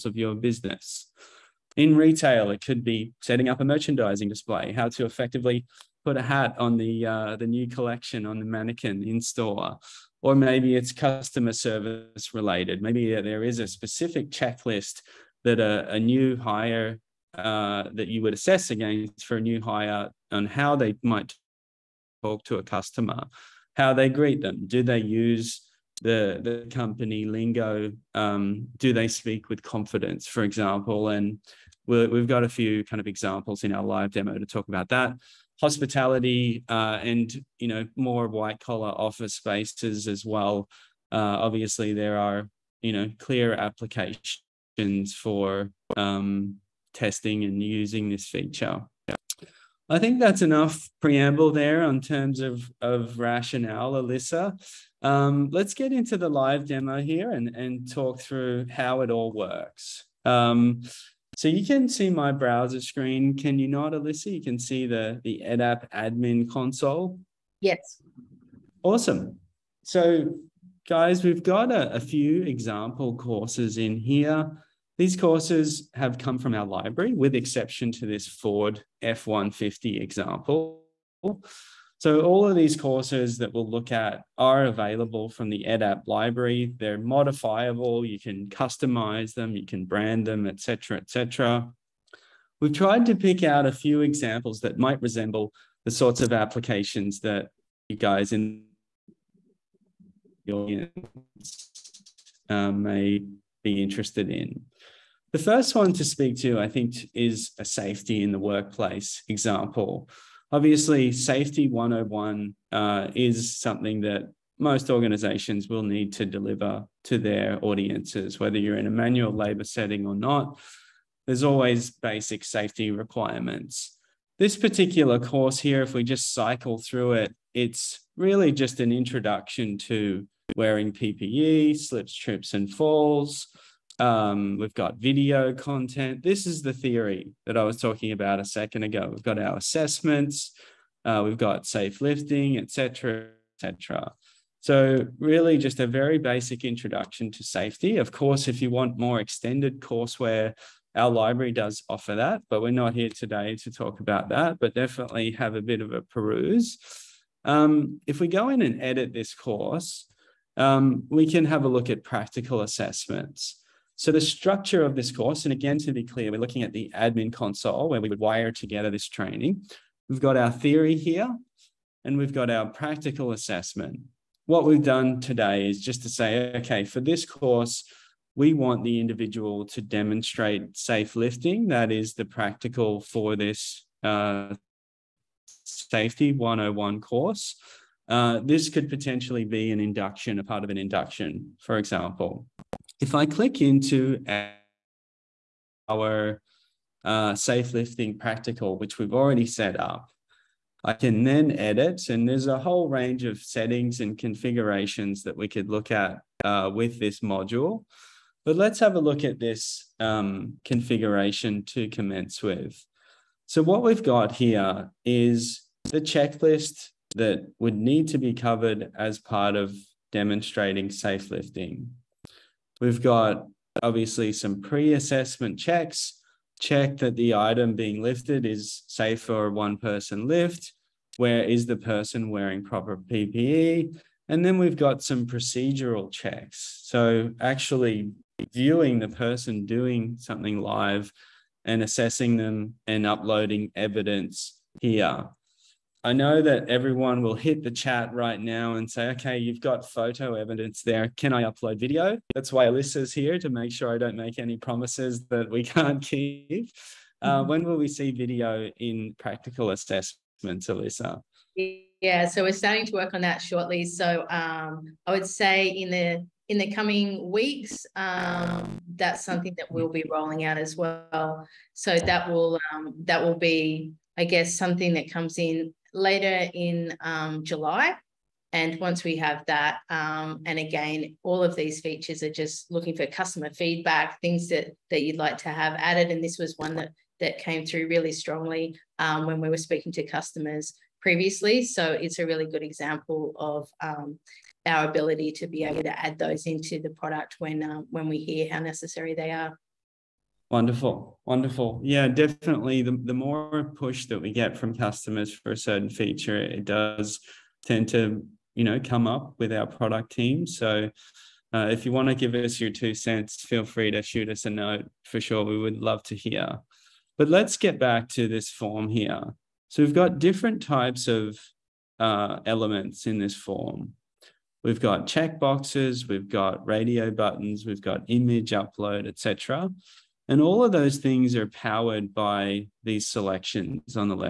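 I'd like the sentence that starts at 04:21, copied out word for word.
Yeah, so we're starting to work on that shortly.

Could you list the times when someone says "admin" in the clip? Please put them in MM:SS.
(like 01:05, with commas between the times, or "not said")
01:05, 02:46.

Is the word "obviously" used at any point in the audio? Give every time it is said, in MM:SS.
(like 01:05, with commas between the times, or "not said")
00:41, 01:50, 03:43.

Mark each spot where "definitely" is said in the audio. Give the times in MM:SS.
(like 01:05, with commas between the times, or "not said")
02:34, 05:02.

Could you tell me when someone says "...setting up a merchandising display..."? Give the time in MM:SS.
00:03.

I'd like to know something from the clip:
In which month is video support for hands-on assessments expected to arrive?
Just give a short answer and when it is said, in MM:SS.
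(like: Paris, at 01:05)
July, at 04:37.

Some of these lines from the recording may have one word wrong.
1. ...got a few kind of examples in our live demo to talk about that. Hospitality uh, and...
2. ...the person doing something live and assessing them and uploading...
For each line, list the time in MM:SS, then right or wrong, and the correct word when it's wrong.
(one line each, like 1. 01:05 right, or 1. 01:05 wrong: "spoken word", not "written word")
1. 00:32 right
2. 03:58 right.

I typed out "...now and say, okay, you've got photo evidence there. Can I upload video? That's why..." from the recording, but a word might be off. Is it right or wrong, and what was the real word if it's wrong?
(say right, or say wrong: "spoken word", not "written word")
right.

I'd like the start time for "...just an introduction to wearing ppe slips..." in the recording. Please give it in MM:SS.
02:08.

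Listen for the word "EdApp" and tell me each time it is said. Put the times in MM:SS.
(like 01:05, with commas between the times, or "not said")
01:05, 01:25.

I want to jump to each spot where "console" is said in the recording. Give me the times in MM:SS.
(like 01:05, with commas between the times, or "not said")
01:06, 02:47.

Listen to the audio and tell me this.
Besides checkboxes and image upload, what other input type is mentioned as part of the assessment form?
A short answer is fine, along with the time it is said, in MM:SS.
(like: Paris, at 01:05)
Radio buttons, at 05:26.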